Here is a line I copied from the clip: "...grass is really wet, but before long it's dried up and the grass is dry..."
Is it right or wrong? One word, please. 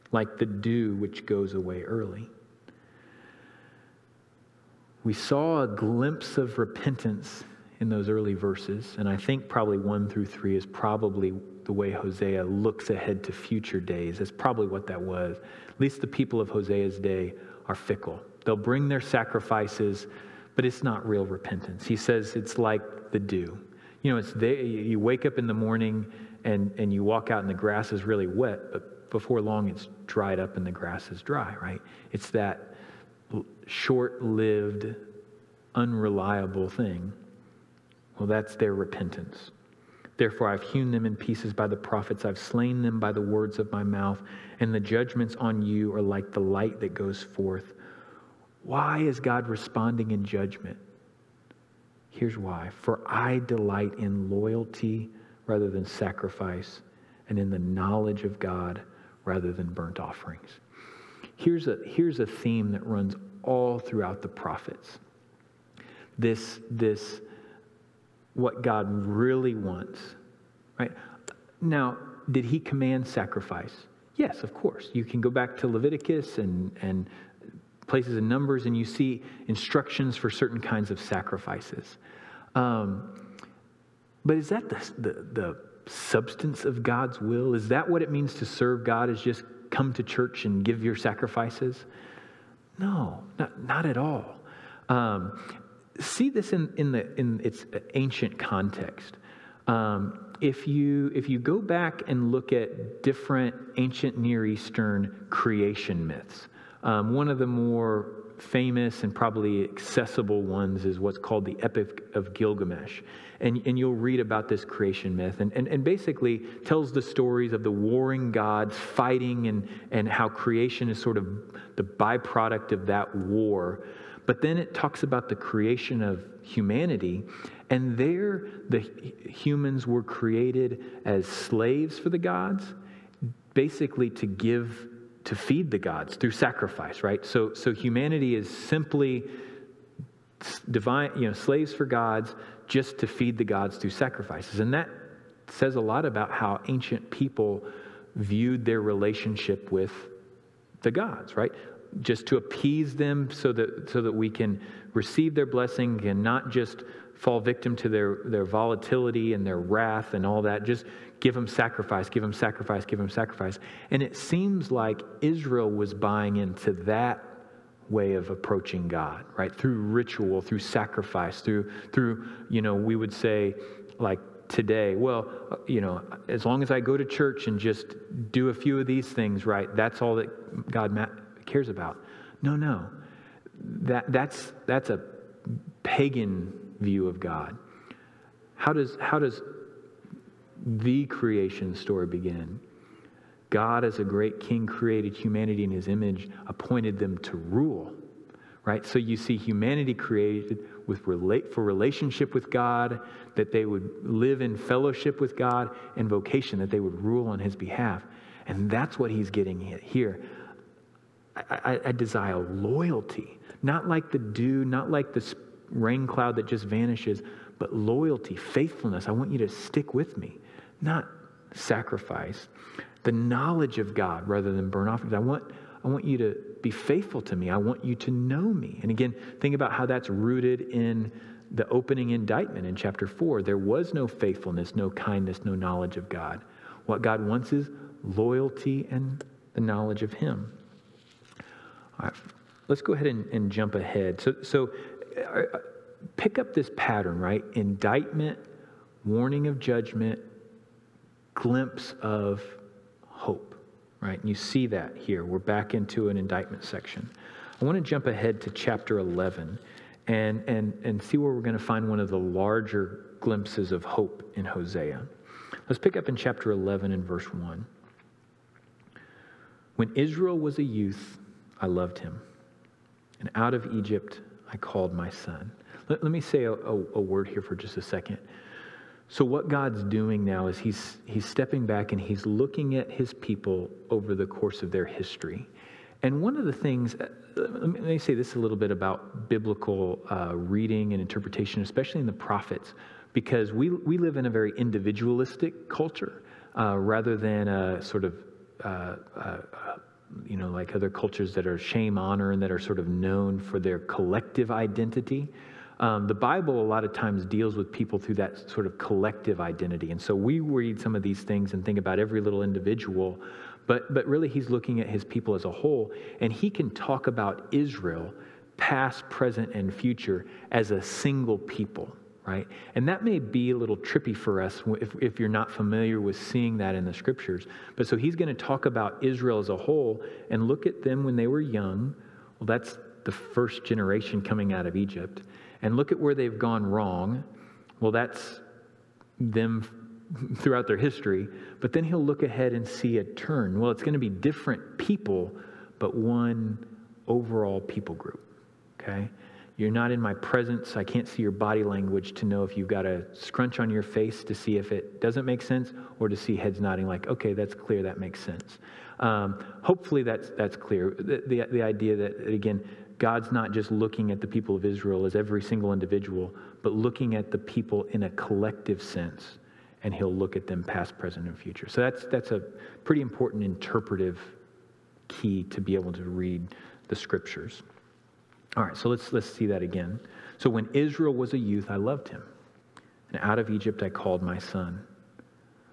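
right.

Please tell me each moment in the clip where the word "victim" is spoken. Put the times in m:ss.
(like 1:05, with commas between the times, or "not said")
2:37.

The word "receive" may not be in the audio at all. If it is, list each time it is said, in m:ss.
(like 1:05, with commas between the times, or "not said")
2:34.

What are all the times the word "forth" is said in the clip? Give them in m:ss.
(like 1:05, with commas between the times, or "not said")
0:47.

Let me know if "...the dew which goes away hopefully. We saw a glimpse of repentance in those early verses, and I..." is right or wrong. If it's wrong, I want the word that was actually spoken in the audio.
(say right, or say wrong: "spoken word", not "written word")
wrong: "early", not "hopefully".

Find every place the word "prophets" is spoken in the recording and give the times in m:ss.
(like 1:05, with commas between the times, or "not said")
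0:41, 1:04, 4:52.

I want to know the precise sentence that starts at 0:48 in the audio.
Why is God responding in judgment?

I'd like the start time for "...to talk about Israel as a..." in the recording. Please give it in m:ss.
5:28.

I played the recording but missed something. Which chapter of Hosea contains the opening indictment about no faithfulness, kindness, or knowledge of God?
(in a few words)
Chapter 4.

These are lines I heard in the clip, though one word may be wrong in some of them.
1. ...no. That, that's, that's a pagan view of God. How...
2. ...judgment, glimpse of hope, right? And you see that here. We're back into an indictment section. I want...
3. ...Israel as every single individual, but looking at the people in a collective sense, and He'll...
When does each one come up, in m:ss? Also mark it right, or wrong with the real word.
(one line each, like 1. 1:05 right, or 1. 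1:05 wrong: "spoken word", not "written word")
1. 3:02 right
2. 4:09 right
3. 6:04 right.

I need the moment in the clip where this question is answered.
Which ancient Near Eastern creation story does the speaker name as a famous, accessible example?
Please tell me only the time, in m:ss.
1:51.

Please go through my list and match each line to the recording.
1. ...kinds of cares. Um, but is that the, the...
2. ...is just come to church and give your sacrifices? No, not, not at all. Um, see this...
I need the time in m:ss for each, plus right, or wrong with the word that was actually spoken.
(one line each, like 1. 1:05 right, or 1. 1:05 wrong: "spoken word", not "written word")
1. 1:20 wrong: "sacrifices", not "cares"
2. 1:29 right.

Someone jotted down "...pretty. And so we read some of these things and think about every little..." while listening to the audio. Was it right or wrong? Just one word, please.
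wrong.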